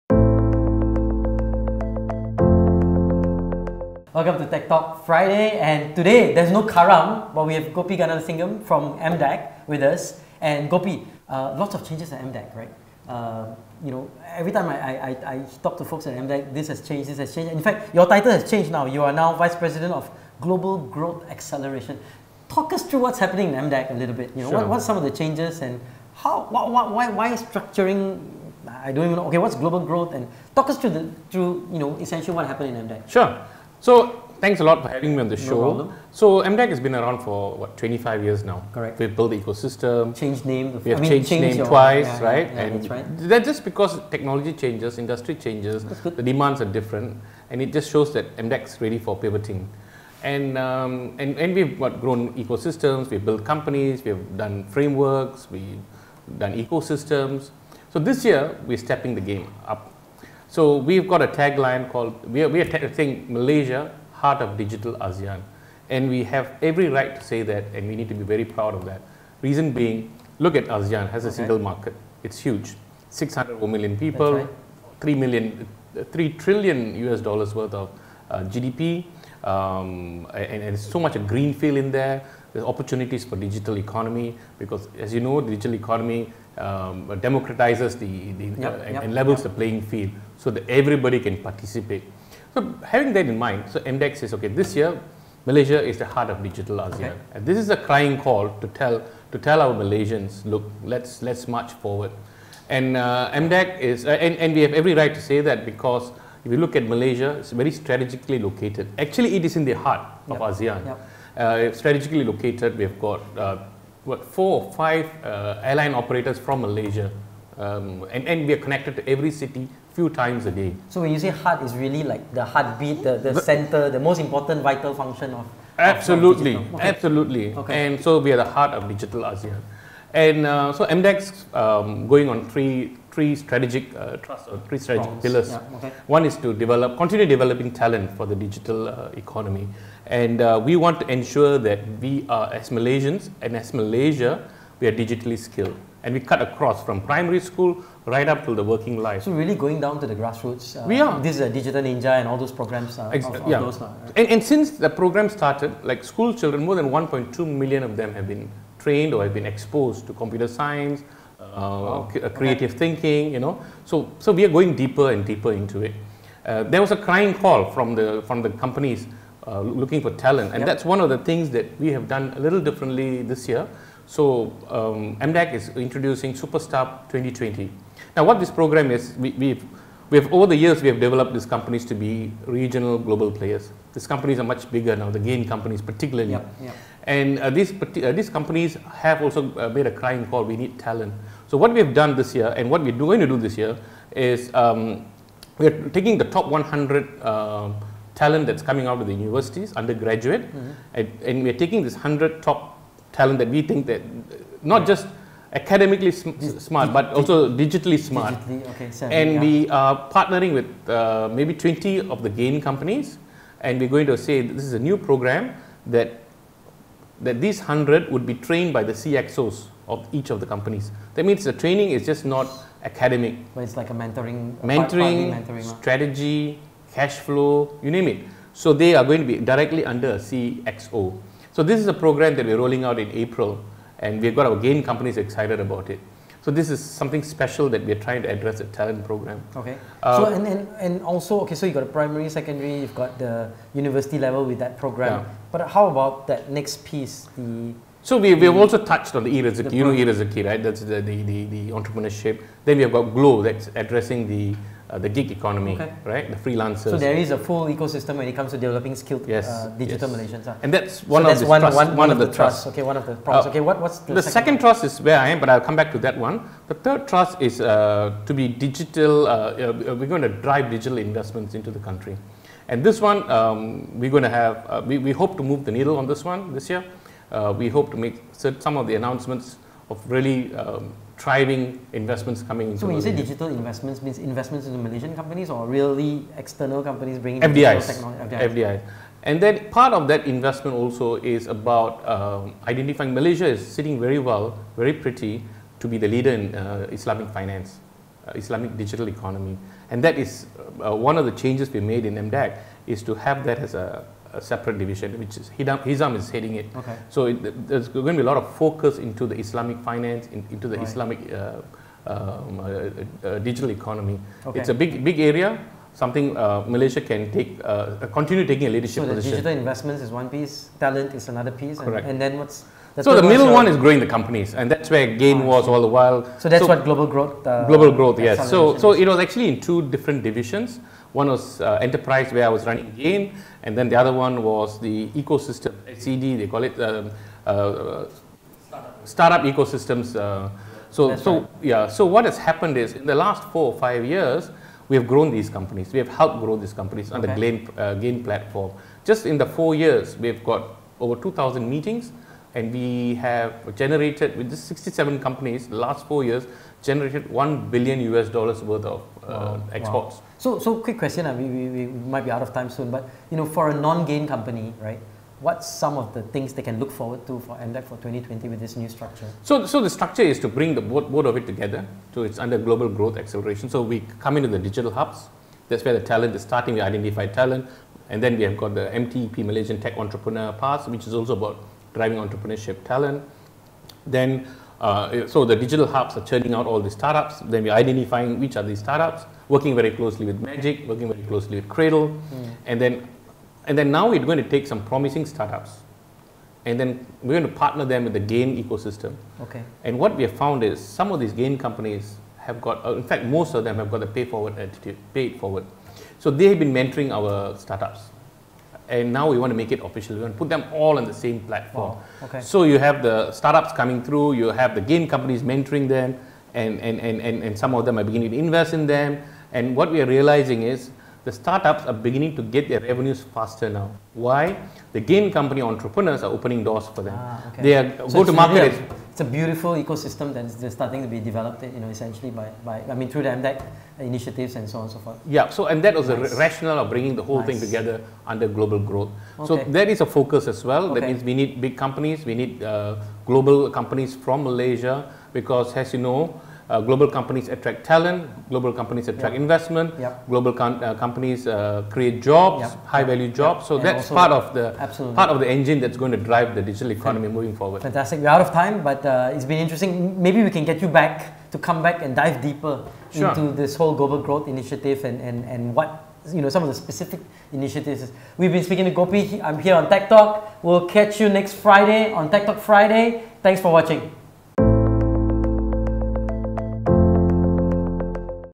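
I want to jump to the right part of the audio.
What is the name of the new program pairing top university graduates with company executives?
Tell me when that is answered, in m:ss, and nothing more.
2:56.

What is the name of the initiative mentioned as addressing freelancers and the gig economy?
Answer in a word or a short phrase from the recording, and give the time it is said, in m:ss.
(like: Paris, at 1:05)
Glow, at 4:13.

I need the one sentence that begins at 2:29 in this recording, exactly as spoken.
So really going down to the grassroots.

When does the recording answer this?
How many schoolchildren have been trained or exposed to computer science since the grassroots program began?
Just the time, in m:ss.
2:36.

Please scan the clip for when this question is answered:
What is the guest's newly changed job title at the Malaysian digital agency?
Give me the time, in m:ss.
0:19.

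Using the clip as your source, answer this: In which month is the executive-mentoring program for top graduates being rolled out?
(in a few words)
April.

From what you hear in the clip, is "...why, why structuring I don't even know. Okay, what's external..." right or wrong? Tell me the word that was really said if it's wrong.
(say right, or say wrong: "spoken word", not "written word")
wrong: "global", not "external".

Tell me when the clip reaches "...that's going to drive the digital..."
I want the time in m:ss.
7:35.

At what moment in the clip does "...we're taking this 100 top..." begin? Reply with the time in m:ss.
3:21.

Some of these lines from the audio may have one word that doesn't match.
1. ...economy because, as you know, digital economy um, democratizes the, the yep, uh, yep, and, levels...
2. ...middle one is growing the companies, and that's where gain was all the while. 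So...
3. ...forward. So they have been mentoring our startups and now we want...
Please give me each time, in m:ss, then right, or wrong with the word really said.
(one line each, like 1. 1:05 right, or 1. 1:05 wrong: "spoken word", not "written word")
1. 1:23 right
2. 5:23 right
3. 6:45 right.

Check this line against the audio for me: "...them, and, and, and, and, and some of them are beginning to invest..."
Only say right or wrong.
right.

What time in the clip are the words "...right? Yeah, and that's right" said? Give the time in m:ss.
0:42.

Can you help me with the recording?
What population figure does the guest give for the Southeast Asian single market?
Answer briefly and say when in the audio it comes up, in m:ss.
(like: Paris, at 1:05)
600 million, at 1:13.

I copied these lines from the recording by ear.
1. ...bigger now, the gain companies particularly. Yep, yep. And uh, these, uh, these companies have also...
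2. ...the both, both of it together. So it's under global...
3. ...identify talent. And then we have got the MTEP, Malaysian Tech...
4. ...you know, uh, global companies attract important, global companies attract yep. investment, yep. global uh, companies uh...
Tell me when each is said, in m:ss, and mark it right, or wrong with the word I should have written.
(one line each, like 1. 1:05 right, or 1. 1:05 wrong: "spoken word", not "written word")
1. 3:04 right
2. 6:10 right
3. 6:16 right
4. 7:25 wrong: "talent", not "important".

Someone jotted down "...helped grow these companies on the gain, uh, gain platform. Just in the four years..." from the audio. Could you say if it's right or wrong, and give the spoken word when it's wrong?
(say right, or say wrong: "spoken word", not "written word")
right.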